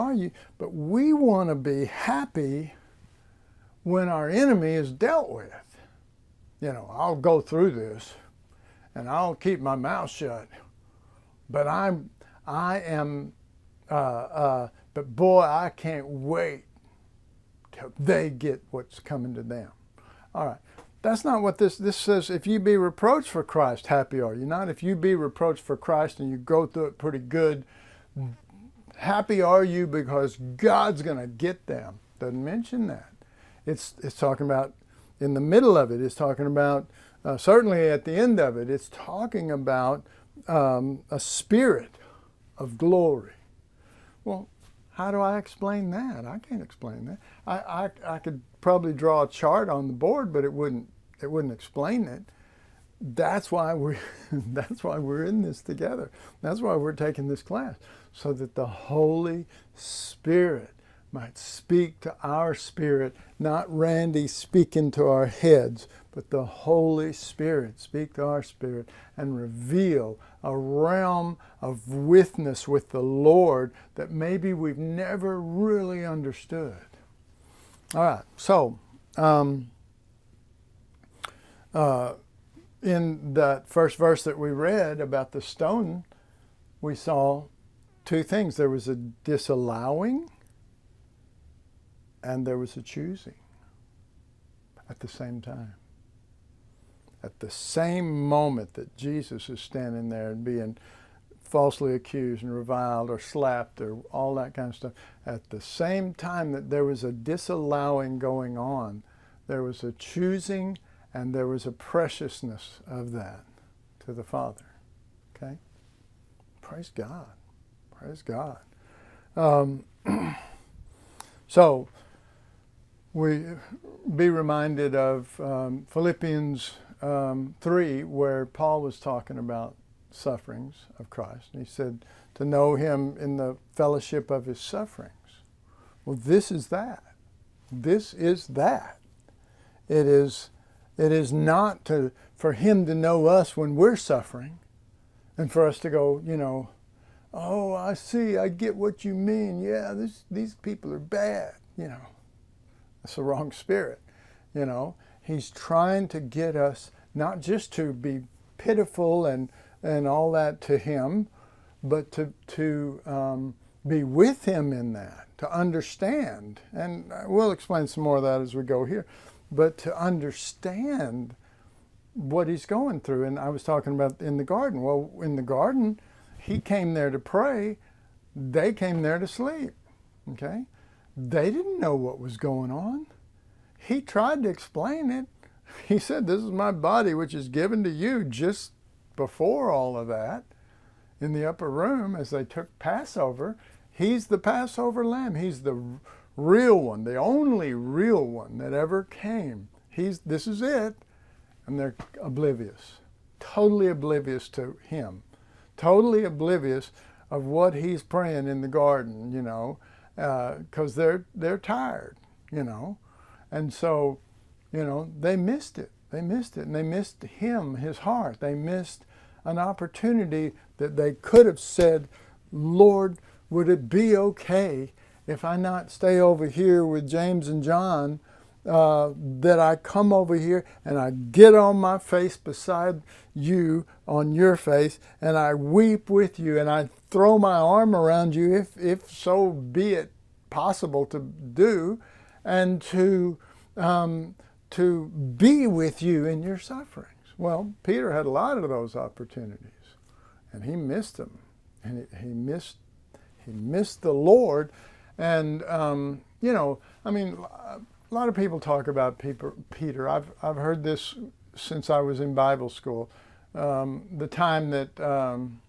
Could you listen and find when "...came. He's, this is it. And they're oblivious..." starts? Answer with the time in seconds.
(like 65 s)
199 s.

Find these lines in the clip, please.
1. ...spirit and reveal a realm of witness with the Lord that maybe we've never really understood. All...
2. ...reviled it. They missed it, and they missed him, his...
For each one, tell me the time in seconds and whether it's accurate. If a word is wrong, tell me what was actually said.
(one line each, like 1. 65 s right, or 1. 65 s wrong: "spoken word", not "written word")
1. 68 s right
2. 215 s wrong: "missed", not "reviled".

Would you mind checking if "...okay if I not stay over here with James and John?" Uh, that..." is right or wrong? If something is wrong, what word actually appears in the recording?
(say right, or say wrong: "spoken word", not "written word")
right.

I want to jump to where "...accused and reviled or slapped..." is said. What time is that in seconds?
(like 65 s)
101 s.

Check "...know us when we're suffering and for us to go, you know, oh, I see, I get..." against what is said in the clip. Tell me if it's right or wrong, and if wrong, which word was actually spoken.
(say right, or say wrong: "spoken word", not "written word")
right.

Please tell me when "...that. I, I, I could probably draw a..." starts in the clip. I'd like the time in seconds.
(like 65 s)
47 s.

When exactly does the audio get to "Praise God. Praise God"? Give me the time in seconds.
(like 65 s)
116 s.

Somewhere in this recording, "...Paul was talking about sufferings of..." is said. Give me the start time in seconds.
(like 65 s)
128 s.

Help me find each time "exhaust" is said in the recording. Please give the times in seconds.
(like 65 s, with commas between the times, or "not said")
not said.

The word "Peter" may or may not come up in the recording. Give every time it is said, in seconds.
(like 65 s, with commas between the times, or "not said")
247 s, 259 s.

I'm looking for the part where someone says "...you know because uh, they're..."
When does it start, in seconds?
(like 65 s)
209 s.